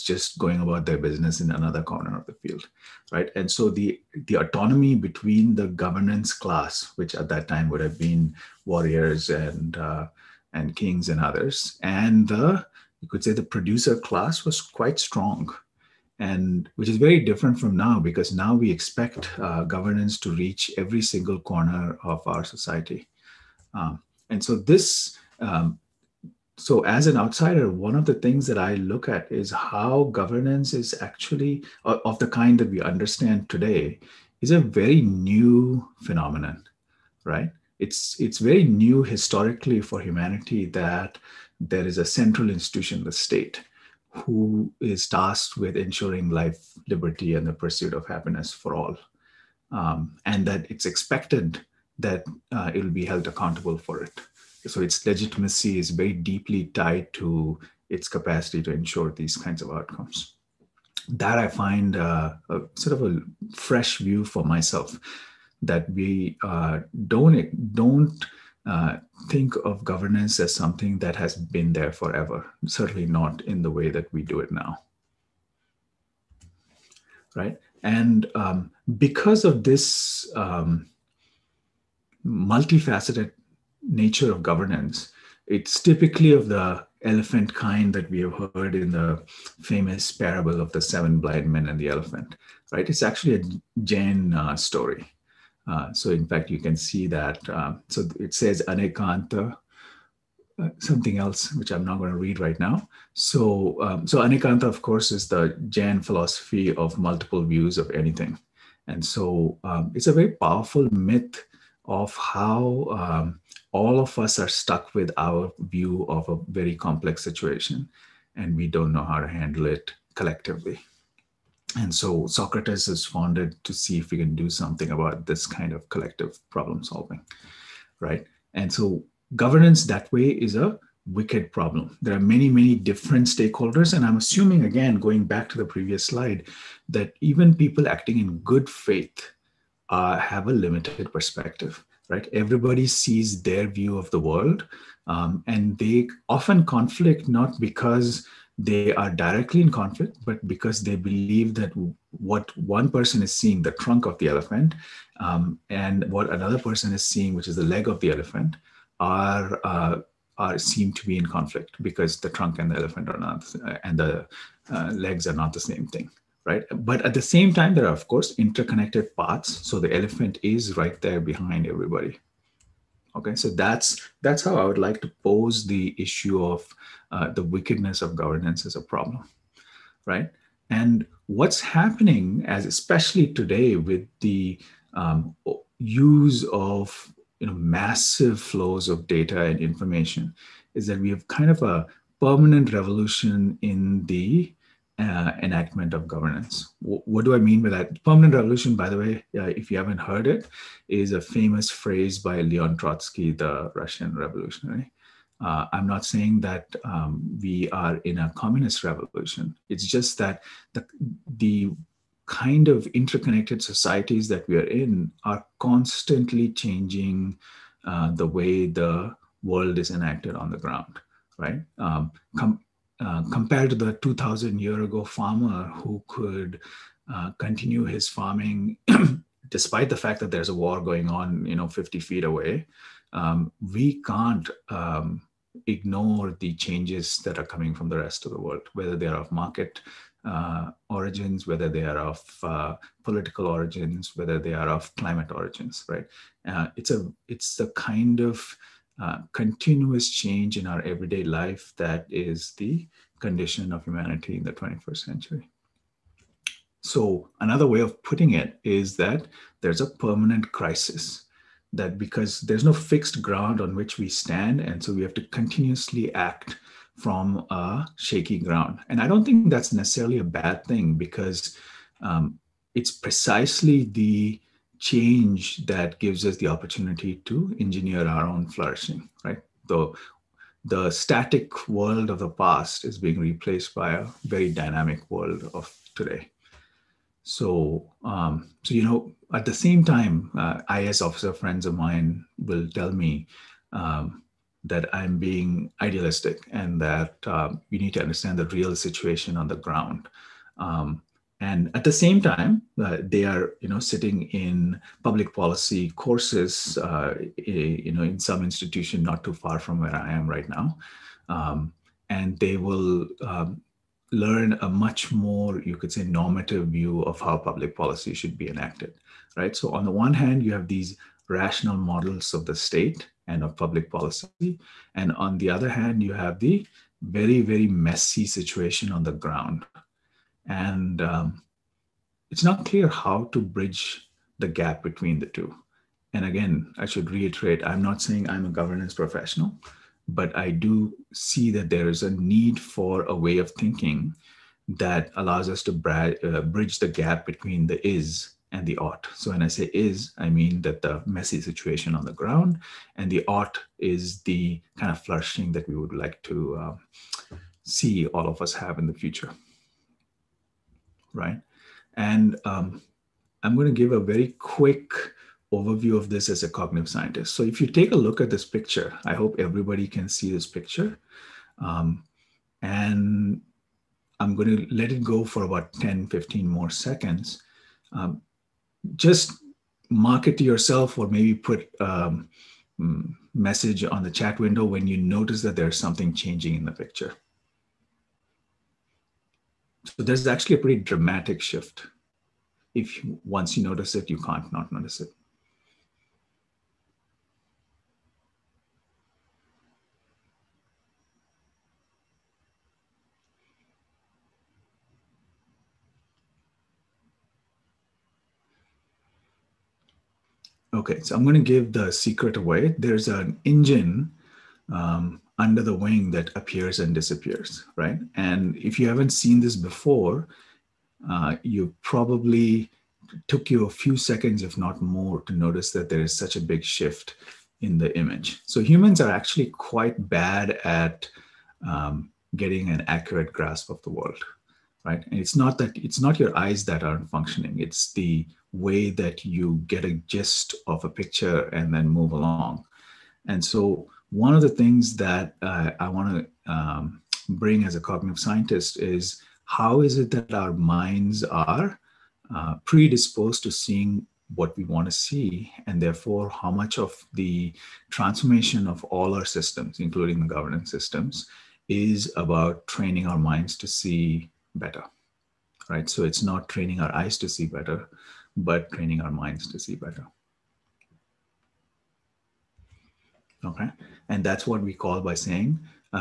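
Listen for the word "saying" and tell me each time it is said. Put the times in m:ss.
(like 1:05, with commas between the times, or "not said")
3:26, 5:38, 7:55.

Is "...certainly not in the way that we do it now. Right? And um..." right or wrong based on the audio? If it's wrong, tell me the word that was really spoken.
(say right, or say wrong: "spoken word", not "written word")
right.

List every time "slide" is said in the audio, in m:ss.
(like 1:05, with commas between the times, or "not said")
2:16.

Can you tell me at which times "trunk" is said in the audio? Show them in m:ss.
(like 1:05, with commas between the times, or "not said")
2:33, 2:42.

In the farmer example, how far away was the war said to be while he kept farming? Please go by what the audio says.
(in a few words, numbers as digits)
50 feet.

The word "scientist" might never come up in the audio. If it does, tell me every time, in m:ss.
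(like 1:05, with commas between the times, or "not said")
6:06, 7:28.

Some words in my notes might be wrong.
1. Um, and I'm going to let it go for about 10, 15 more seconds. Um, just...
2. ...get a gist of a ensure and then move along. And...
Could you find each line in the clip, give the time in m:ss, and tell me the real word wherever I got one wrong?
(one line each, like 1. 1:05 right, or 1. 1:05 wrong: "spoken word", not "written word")
1. 6:11 right
2. 7:19 wrong: "picture", not "ensure".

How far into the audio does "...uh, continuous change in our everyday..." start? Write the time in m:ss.
4:08.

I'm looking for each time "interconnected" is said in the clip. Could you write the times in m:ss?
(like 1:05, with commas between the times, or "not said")
2:48, 3:32.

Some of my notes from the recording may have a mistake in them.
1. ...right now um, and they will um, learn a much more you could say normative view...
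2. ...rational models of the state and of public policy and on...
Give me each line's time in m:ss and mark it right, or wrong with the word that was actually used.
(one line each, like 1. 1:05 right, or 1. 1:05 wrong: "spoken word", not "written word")
1. 5:10 right
2. 5:21 right.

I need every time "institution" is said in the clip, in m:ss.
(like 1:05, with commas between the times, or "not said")
0:42, 5:08.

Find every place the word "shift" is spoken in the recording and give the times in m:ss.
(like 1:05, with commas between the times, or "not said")
6:31, 7:06.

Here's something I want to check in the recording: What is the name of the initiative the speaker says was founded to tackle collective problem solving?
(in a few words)
Socratus.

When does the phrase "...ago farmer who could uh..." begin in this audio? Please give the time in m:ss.
3:44.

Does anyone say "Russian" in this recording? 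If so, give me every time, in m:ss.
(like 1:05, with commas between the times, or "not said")
3:23.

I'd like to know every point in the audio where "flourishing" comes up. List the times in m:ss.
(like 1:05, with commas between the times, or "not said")
4:38, 5:55.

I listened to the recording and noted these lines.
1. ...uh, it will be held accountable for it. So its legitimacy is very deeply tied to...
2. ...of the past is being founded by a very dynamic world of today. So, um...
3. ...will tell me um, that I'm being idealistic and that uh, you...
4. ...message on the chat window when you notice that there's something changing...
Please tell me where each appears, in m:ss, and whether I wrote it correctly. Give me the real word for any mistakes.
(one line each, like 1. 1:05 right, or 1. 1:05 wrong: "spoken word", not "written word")
1. 0:52 right
2. 4:42 wrong: "replaced", not "founded"
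3. 4:52 right
4. 6:23 right.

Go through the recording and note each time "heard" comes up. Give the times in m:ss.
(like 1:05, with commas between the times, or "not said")
1:28, 3:19.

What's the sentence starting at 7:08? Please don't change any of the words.
So humans are actually quite bad at um, getting an accurate grasp of the world, right?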